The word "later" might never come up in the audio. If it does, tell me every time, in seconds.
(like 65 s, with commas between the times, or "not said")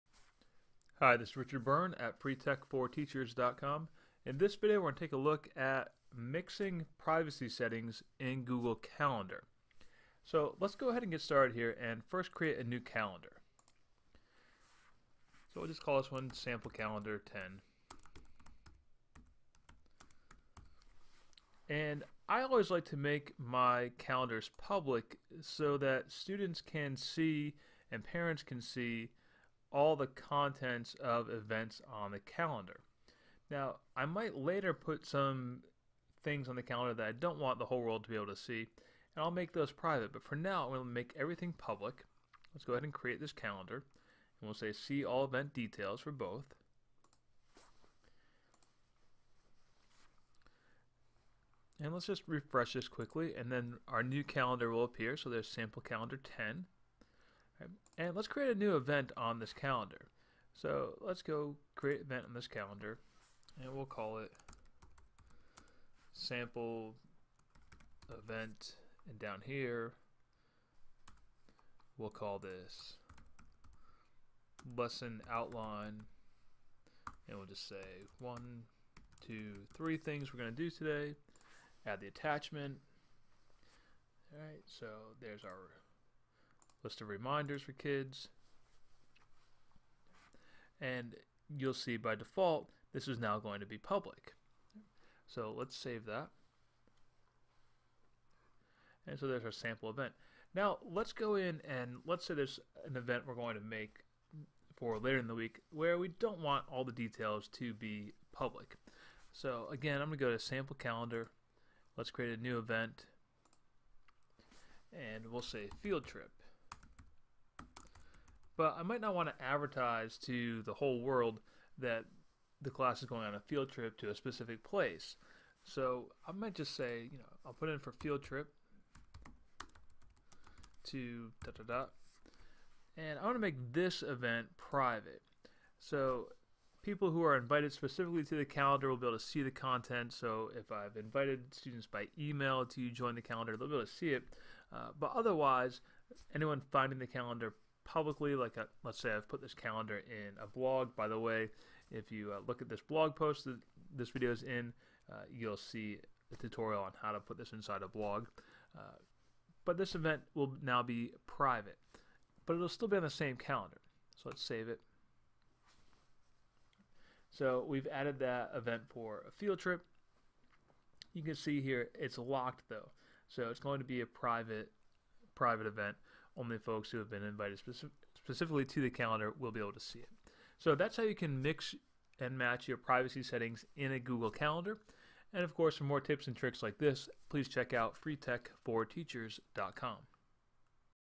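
34 s, 104 s.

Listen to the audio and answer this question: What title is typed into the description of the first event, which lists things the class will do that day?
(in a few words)
lesson outline.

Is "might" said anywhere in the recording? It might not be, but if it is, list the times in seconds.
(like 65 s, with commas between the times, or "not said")
34 s, 118 s, 126 s.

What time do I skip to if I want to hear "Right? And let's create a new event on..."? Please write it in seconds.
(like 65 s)
57 s.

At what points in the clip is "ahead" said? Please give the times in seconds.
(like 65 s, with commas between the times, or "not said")
10 s, 42 s.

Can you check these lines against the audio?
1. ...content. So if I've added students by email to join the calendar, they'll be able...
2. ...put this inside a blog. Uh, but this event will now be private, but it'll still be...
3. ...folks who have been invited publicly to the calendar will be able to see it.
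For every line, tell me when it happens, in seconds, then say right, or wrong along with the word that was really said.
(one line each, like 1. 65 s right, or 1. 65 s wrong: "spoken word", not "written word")
1. 139 s wrong: "invited", not "added"
2. 157 s right
3. 176 s wrong: "specifically", not "publicly".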